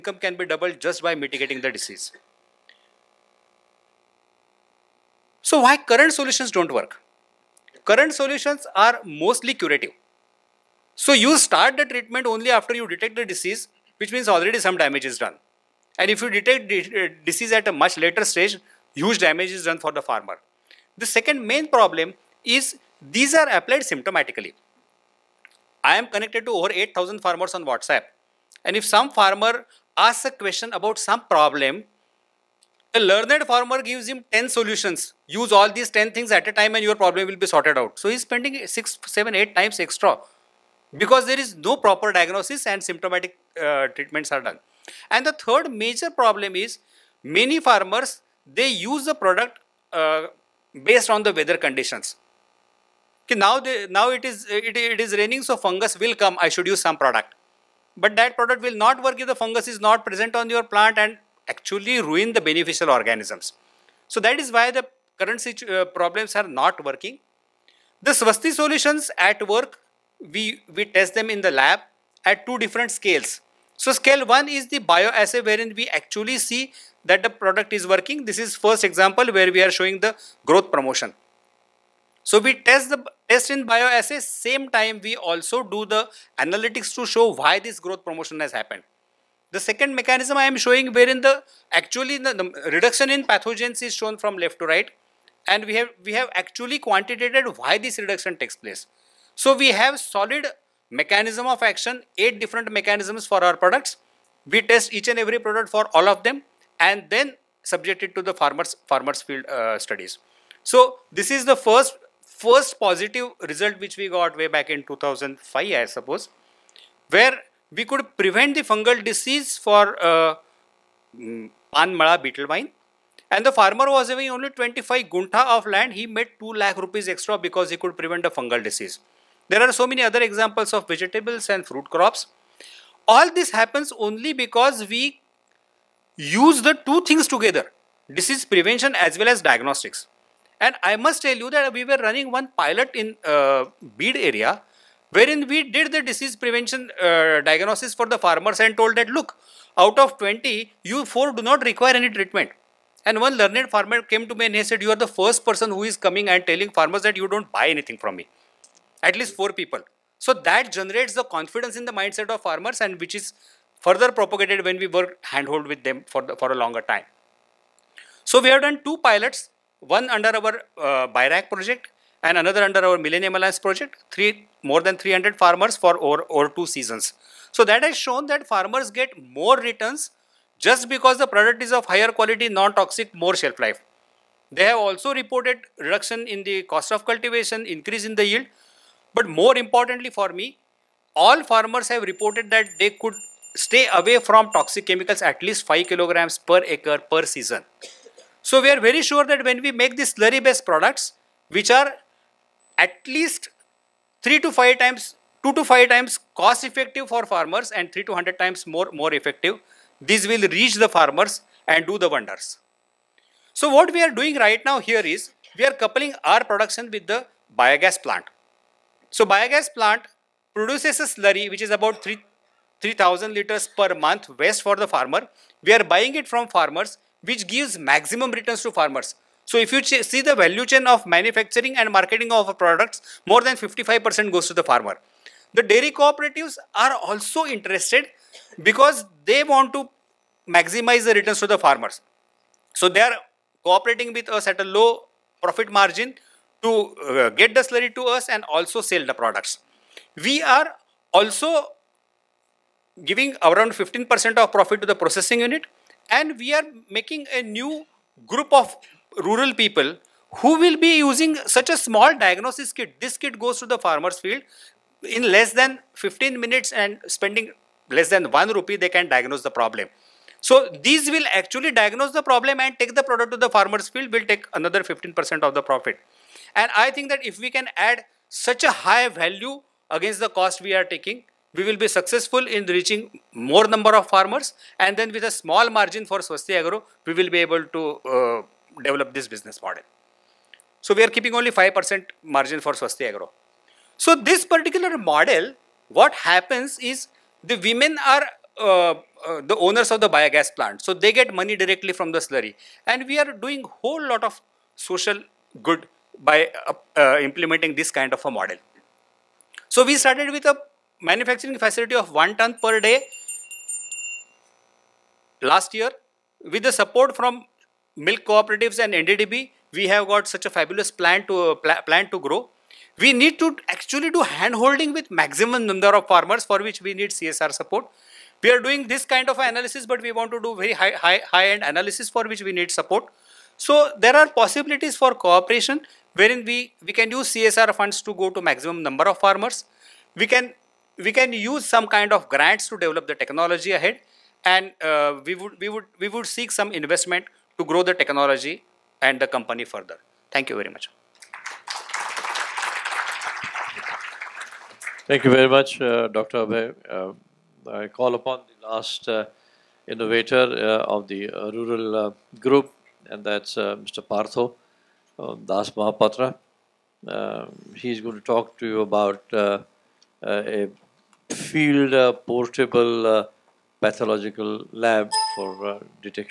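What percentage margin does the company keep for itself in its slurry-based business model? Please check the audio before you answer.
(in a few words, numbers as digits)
5%.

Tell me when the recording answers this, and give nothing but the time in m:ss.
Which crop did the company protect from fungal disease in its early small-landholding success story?
2:01.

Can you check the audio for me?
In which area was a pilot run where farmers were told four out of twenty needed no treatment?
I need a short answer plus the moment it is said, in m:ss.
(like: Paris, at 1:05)
Beed, at 2:23.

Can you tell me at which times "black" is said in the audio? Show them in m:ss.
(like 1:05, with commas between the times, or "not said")
not said.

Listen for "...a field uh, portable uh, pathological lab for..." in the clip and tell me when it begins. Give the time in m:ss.
6:09.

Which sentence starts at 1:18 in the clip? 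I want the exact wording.
This is first example where we are showing the growth promotion.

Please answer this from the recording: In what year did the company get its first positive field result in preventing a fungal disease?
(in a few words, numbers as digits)
2005.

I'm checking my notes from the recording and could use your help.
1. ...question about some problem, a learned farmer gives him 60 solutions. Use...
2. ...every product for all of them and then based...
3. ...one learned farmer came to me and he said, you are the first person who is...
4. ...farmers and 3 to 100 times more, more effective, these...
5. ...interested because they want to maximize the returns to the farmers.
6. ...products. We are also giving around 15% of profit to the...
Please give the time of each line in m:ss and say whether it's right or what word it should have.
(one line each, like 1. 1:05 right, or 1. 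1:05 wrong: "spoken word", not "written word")
1. 0:30 wrong: "10", not "60"
2. 1:45 wrong: "subjected", not "based"
3. 2:33 right
4. 3:27 right
5. 3:57 right
6. 4:09 right.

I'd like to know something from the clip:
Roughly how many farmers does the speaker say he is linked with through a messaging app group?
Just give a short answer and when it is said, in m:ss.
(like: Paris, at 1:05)
8,000, at 0:26.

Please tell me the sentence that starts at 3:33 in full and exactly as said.
So what we are doing right now here is, we are coupling our production with the biogas plant.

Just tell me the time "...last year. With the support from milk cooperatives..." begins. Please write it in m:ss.
5:15.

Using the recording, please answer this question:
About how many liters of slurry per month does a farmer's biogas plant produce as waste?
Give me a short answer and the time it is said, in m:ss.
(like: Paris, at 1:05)
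3,000 liters, at 3:42.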